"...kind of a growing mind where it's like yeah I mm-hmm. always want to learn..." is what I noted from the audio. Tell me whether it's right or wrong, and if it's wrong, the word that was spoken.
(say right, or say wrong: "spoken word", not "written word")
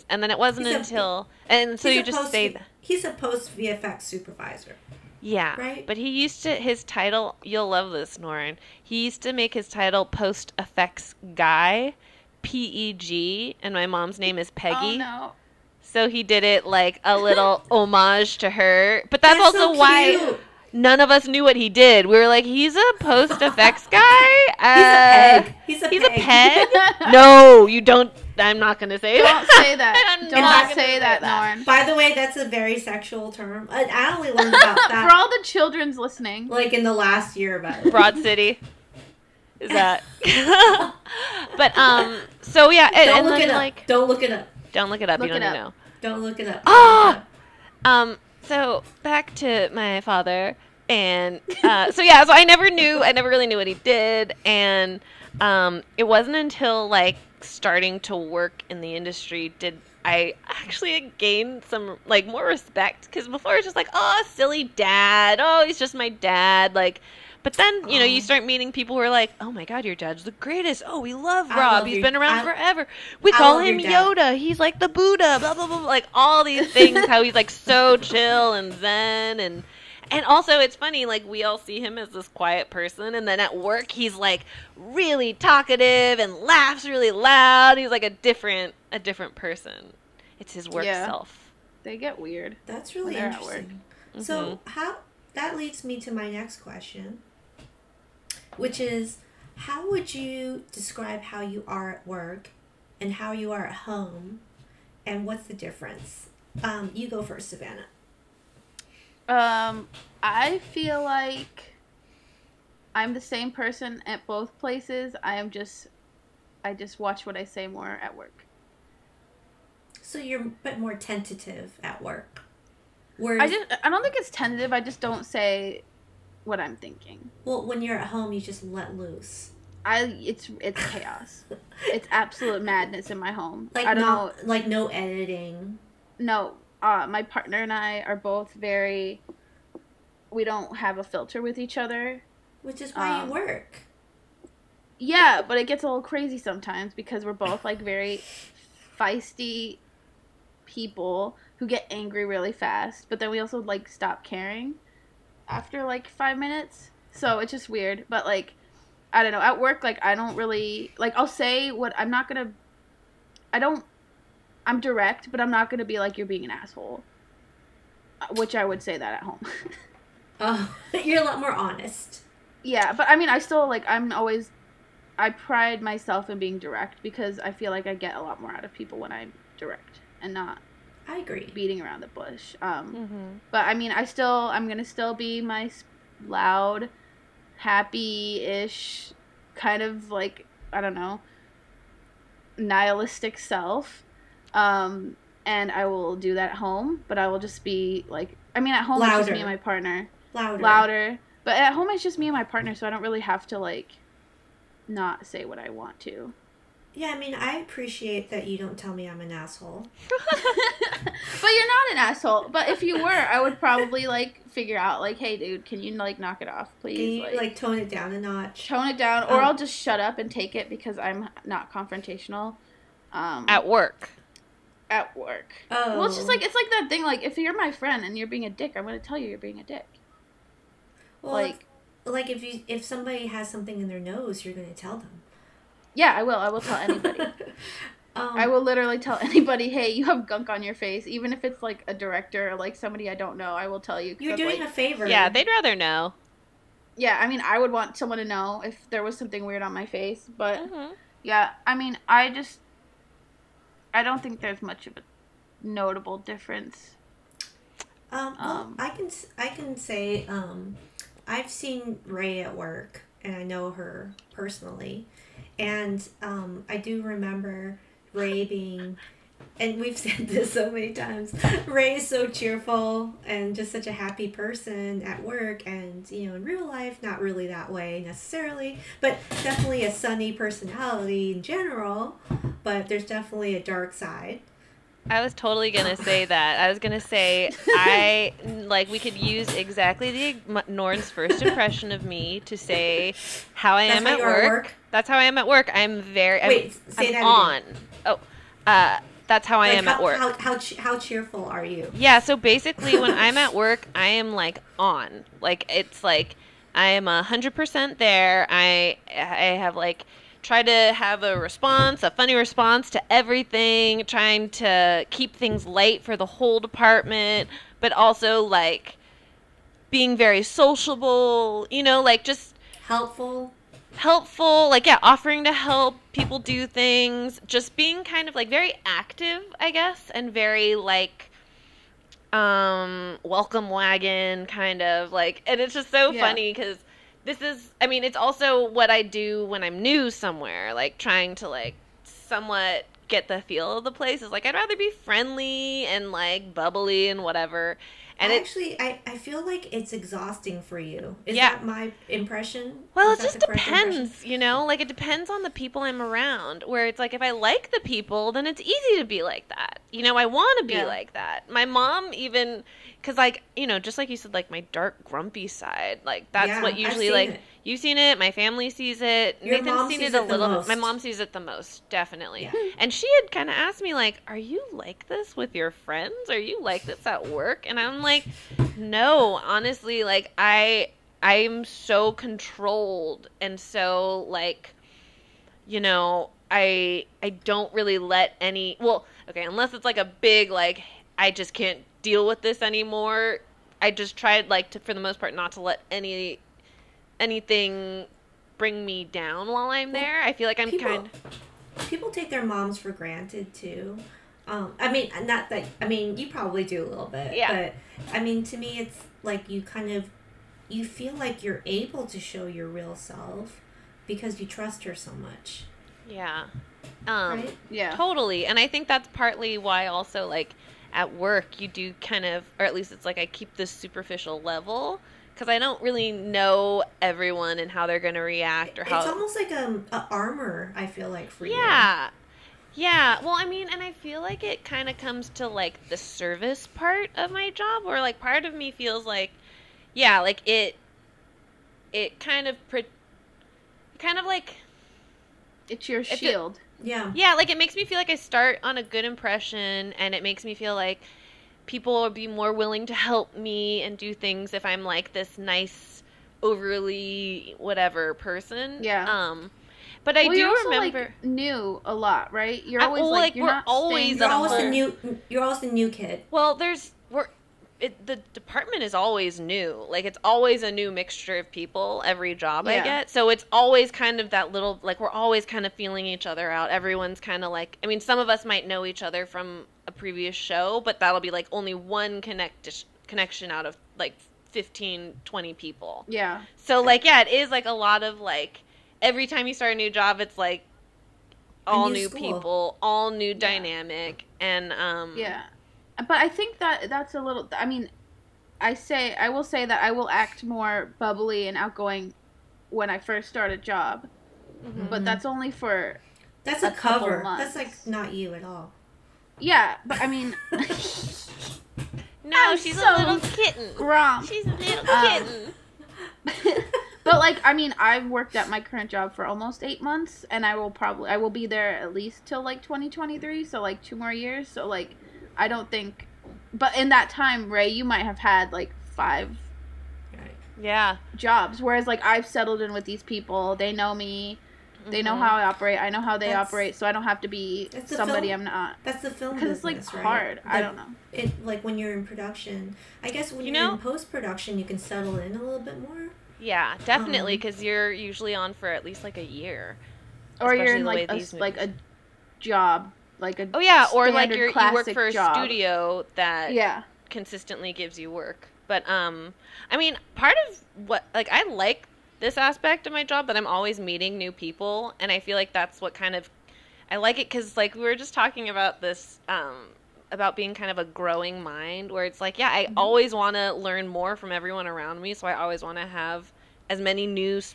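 right.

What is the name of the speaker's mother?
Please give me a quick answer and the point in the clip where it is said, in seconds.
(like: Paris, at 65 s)
Peggy, at 14 s.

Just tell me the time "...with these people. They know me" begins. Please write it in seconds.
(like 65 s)
532 s.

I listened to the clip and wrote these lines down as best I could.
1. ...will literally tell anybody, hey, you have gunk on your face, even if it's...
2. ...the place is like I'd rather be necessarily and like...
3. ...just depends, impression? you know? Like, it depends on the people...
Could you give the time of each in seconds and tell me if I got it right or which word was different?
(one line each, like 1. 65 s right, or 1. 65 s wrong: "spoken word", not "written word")
1. 238 s right
2. 343 s wrong: "friendly", not "necessarily"
3. 353 s right.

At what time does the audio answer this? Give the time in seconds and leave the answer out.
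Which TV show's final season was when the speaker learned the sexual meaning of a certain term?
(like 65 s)
37 s.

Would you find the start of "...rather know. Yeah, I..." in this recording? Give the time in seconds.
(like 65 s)
245 s.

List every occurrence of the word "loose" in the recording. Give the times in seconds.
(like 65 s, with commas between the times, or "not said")
128 s.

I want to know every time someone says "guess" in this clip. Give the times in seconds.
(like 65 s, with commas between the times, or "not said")
329 s, 543 s.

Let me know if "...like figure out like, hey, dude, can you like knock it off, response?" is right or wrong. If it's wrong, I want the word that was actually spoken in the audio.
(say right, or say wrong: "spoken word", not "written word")
wrong: "please", not "response".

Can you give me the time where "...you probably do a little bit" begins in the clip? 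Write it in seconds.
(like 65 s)
406 s.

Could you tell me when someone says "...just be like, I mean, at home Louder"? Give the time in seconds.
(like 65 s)
197 s.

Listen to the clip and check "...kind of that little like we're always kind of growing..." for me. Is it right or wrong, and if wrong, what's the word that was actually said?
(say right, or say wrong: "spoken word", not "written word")
wrong: "feeling", not "growing".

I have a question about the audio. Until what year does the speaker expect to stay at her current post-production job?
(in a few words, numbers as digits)
2023.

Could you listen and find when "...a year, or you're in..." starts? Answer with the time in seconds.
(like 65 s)
549 s.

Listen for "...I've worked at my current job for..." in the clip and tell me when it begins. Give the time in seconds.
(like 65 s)
517 s.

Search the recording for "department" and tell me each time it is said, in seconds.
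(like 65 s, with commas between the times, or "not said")
316 s, 468 s.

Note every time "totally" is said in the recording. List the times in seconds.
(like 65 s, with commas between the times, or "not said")
285 s, 417 s.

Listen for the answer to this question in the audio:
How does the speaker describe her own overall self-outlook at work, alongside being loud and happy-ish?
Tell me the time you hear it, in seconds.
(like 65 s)
192 s.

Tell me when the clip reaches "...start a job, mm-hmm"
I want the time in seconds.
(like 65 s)
503 s.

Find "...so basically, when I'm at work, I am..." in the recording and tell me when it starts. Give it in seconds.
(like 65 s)
302 s.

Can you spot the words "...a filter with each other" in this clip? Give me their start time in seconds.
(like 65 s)
140 s.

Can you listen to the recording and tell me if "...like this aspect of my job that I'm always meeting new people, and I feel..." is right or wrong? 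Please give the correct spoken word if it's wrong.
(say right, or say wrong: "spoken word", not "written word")
right.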